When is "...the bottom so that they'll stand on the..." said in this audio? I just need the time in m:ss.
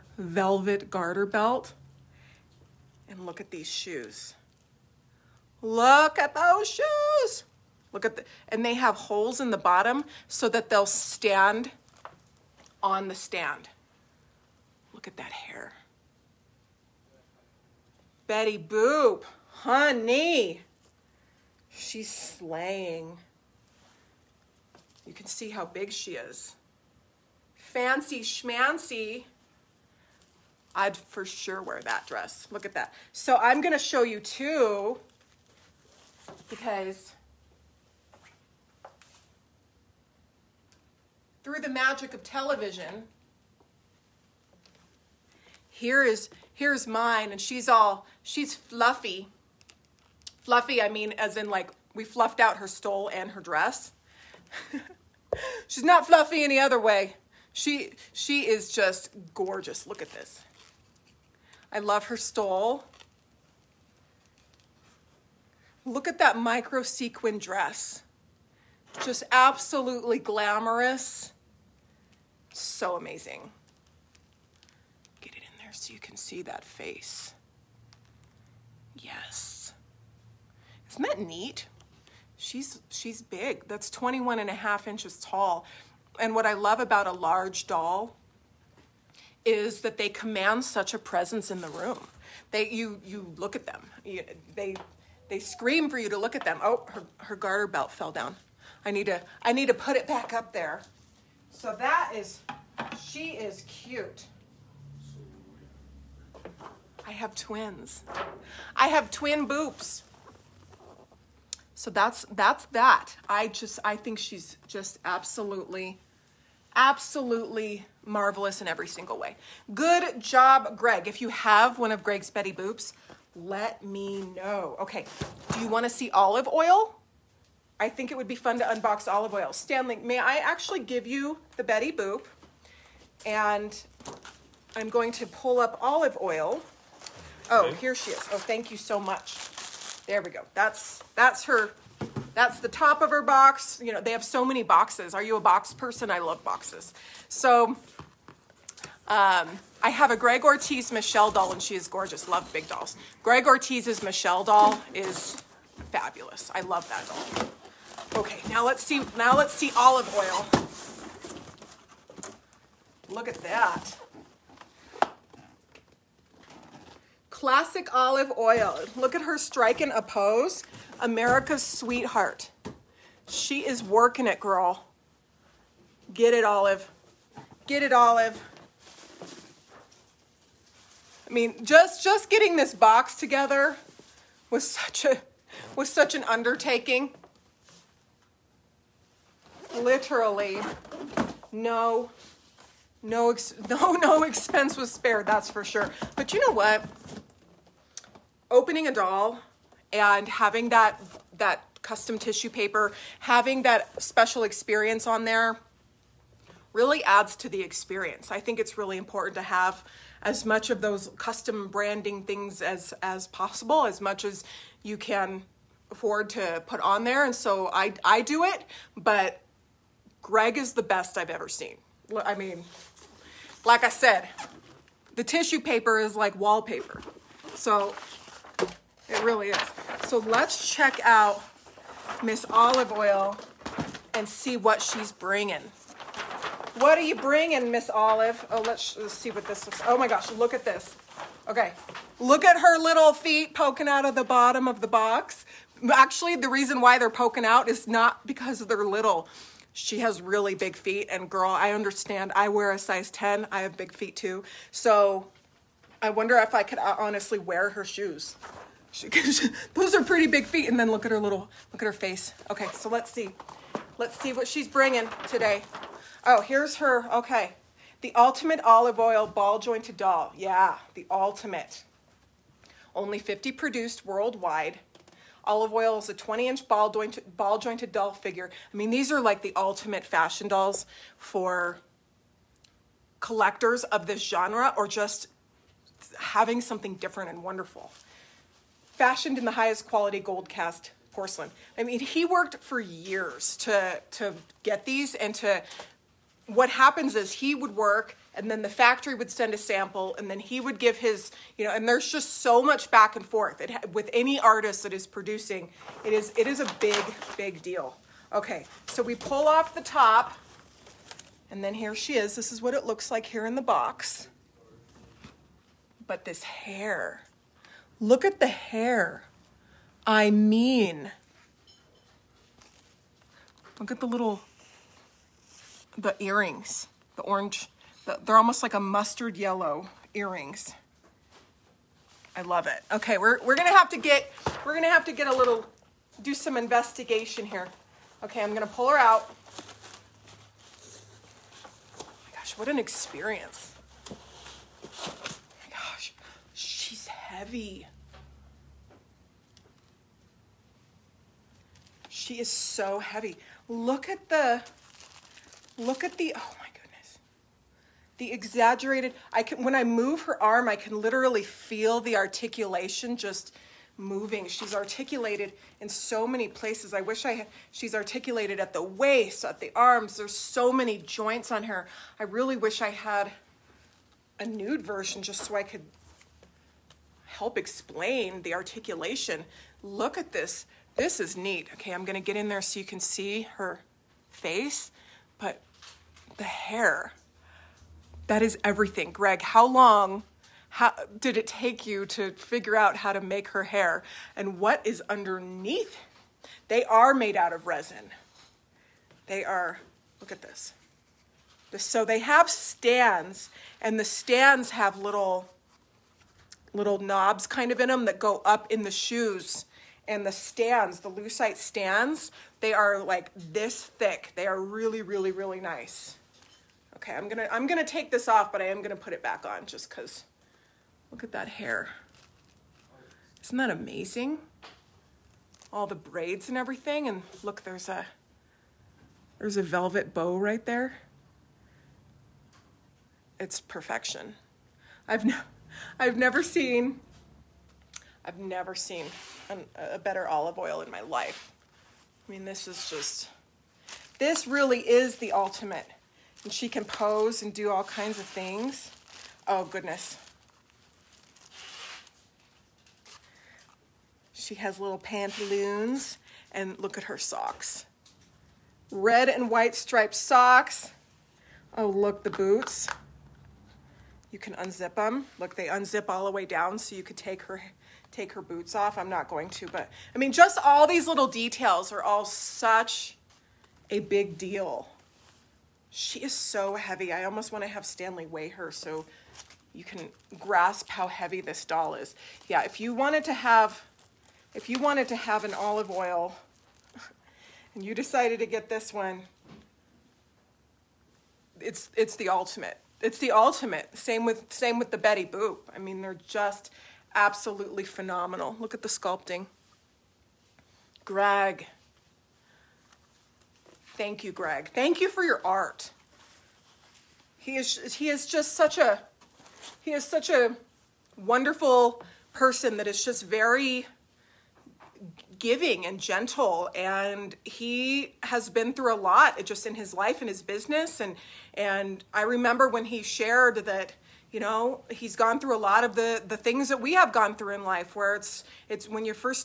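0:09.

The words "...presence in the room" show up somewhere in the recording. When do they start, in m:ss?
1:30.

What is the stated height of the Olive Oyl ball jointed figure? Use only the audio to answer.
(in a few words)
20 inches.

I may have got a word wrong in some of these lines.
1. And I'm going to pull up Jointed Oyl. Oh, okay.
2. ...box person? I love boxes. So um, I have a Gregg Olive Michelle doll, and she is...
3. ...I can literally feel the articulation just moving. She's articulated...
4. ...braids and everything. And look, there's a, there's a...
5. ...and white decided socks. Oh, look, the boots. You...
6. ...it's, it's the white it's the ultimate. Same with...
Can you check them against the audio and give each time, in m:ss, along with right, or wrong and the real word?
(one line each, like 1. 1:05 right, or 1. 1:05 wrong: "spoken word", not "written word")
1. 2:13 wrong: "Olive", not "Jointed"
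2. 2:25 wrong: "Ortiz", not "Olive"
3. 6:00 right
4. 7:05 right
5. 7:39 wrong: "striped", not "decided"
6. 8:11 wrong: "ultimate", not "white".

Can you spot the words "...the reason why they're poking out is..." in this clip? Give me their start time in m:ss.
4:06.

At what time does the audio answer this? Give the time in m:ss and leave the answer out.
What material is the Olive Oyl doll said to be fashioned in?
4:50.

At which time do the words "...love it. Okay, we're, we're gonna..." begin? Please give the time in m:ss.
5:32.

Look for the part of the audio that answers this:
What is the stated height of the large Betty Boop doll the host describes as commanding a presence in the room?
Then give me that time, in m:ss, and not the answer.
1:23.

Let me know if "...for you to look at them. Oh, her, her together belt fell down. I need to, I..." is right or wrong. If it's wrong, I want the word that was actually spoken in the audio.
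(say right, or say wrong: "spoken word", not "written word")
wrong: "garter", not "together".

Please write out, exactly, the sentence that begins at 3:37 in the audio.
And so I I do it, but Gregg is the best I've ever seen.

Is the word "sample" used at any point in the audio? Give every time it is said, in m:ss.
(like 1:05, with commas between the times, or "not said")
4:59.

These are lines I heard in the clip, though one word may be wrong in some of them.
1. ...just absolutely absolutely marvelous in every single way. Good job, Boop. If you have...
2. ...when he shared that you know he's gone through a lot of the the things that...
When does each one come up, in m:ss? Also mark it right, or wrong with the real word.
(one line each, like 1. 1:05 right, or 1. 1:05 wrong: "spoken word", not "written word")
1. 1:54 wrong: "Gregg", not "Boop"
2. 8:42 right.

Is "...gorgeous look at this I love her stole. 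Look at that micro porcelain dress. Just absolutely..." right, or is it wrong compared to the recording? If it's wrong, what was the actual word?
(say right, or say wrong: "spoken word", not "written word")
wrong: "sequin", not "porcelain".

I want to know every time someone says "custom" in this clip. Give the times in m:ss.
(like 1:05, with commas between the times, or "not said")
3:21, 3:31.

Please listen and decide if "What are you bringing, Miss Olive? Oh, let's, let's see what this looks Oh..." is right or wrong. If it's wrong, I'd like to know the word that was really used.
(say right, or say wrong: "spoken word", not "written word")
right.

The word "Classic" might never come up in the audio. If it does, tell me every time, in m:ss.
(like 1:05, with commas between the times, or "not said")
2:47.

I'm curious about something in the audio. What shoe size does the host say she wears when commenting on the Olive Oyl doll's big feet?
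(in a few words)
10.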